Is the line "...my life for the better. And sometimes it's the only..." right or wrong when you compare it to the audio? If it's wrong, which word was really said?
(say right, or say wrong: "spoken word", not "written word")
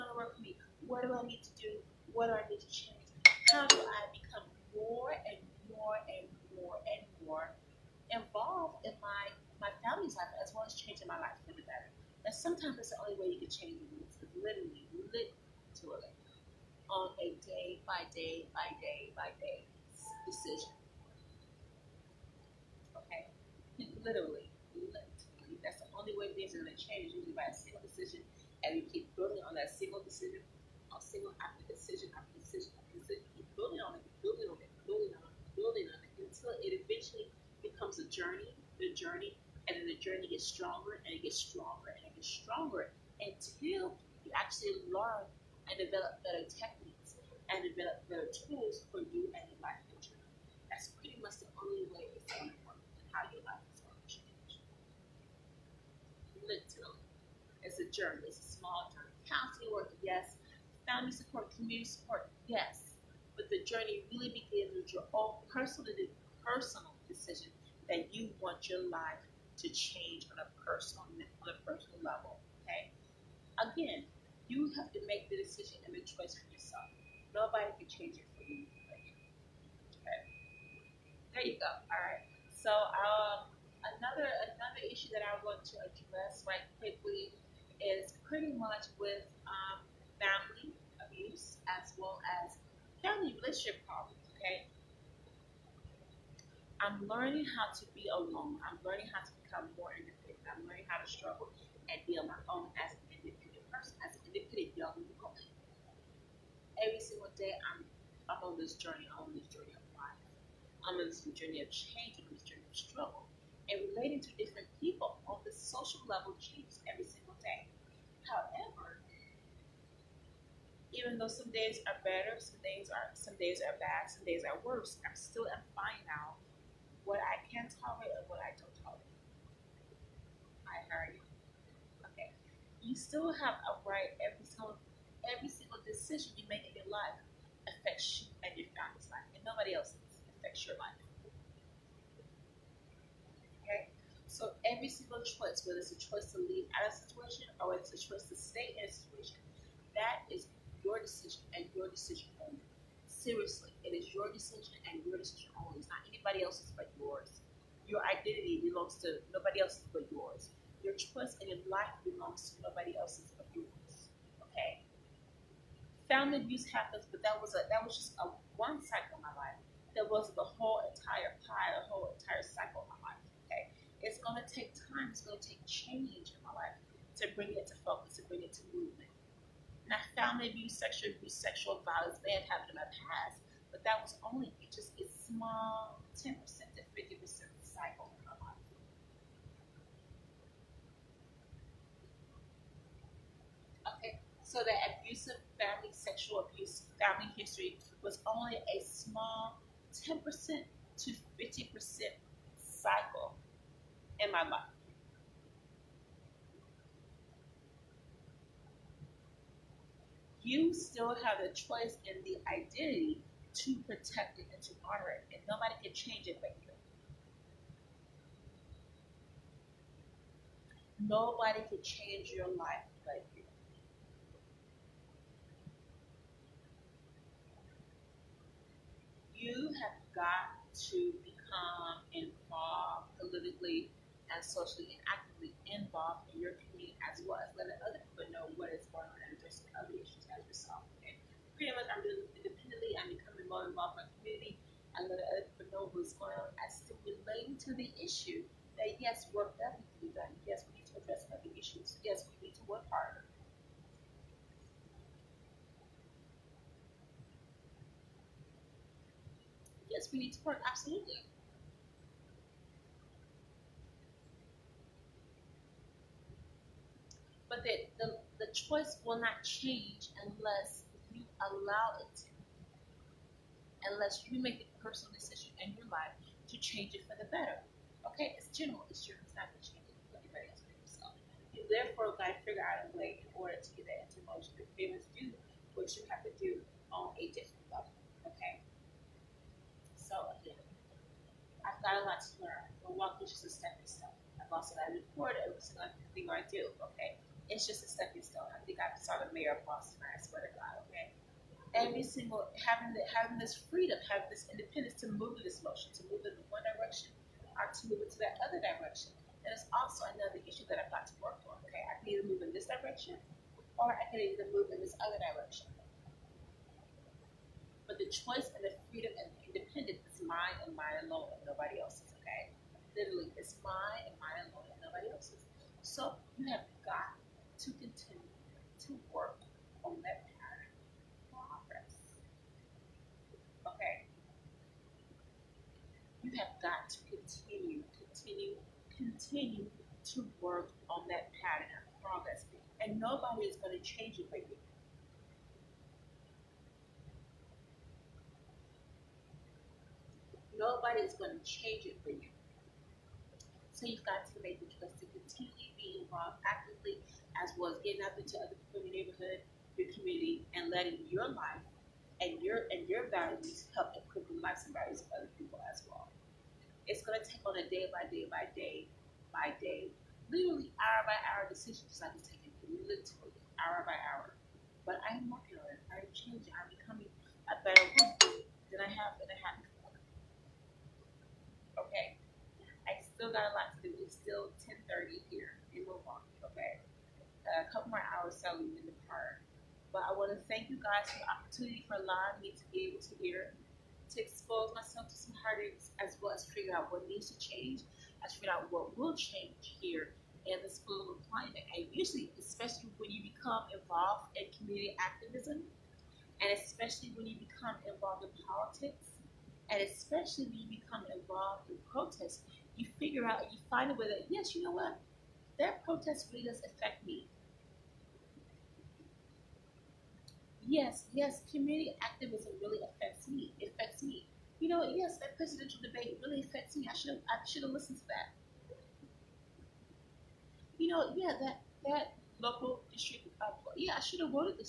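right.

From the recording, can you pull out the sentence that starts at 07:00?
yes, yes, community activism really affects me.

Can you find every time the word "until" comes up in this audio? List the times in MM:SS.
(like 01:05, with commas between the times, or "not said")
00:36, 00:43.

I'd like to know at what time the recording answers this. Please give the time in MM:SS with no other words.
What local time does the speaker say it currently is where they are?
06:24.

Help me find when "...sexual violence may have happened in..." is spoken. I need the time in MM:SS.
03:01.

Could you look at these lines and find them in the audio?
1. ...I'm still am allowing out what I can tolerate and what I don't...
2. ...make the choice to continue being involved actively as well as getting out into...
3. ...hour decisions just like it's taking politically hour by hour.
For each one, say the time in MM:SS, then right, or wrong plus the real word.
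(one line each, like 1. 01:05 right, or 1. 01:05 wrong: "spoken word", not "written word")
1. 02:05 wrong: "finding", not "allowing"
2. 05:54 right
3. 06:11 wrong: "literally", not "politically".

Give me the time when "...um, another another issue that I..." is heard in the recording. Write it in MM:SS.
01:22.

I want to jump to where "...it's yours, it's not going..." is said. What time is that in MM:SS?
04:38.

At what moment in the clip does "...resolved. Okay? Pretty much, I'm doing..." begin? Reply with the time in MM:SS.
04:00.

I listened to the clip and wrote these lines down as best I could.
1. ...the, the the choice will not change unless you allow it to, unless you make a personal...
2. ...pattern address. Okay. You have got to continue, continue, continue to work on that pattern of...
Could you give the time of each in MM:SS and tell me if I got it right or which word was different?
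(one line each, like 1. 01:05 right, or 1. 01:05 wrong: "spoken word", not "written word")
1. 04:27 right
2. 05:30 wrong: "progress", not "address".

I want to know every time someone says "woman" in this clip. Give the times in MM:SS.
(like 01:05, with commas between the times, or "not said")
01:45, 06:18.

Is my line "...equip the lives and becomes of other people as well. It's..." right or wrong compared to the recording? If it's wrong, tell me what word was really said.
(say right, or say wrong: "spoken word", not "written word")
wrong: "values", not "becomes".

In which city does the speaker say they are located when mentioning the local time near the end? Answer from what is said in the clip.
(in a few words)
Milwaukee.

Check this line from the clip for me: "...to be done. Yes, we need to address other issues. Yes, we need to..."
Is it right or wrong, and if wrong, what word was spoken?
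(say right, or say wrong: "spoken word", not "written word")
right.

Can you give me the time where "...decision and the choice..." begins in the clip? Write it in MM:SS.
01:15.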